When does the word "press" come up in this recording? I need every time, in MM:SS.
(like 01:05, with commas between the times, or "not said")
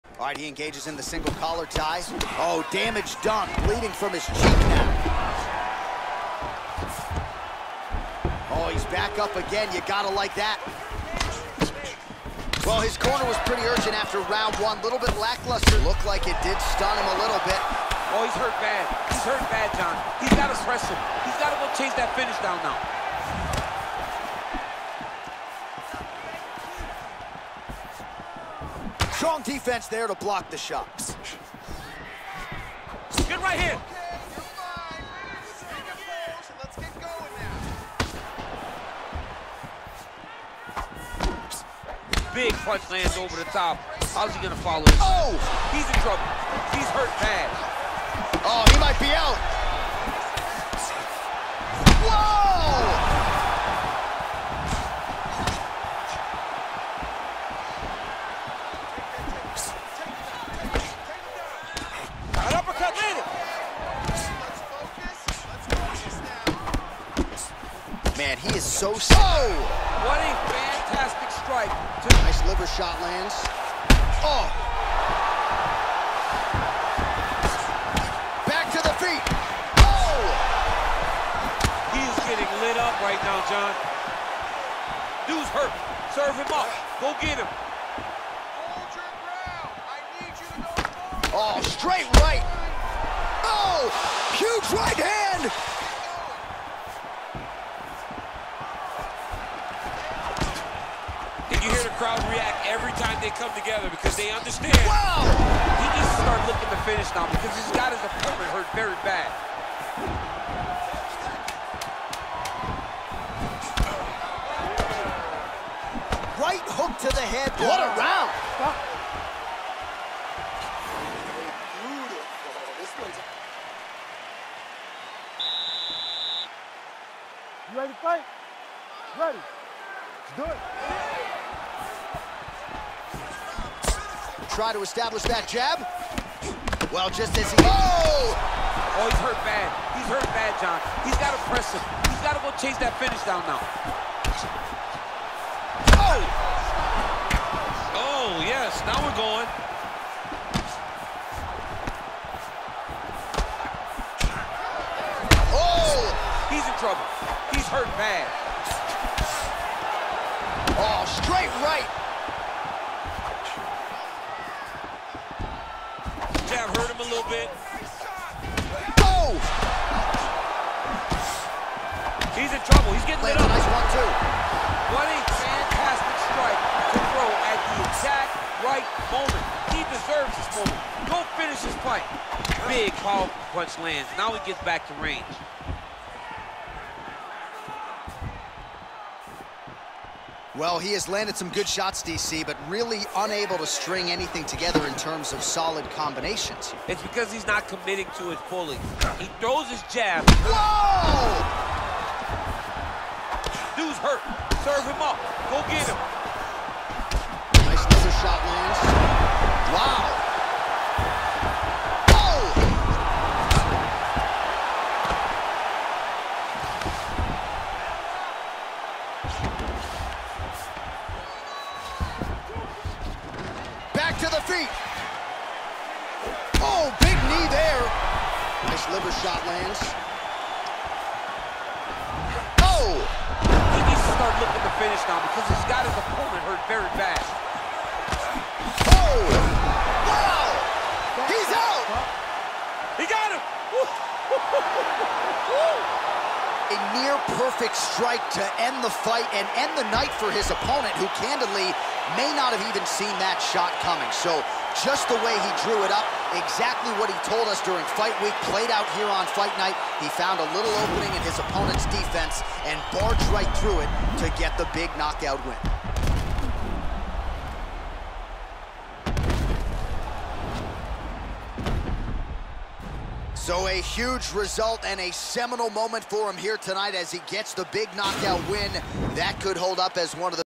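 00:20, 02:21.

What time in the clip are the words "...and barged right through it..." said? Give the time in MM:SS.
04:22.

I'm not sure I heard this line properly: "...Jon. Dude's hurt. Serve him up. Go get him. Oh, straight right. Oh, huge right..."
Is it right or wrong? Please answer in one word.
right.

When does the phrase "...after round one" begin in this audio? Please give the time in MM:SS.
00:13.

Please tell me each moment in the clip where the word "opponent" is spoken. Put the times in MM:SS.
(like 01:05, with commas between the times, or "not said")
01:48, 03:55, 04:10, 04:21.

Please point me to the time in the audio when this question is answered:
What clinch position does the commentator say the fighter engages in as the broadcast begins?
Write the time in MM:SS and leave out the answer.
00:01.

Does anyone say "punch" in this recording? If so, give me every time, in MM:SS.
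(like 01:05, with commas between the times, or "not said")
00:42, 03:03.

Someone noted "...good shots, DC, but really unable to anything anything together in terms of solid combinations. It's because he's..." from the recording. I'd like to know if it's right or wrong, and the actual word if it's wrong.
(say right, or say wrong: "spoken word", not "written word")
wrong: "string", not "anything".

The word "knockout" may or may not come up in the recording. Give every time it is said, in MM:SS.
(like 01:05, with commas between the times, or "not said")
04:24, 04:37.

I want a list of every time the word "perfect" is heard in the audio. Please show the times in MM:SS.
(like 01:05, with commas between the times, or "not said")
04:07.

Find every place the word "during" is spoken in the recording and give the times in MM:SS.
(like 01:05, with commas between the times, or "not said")
04:17.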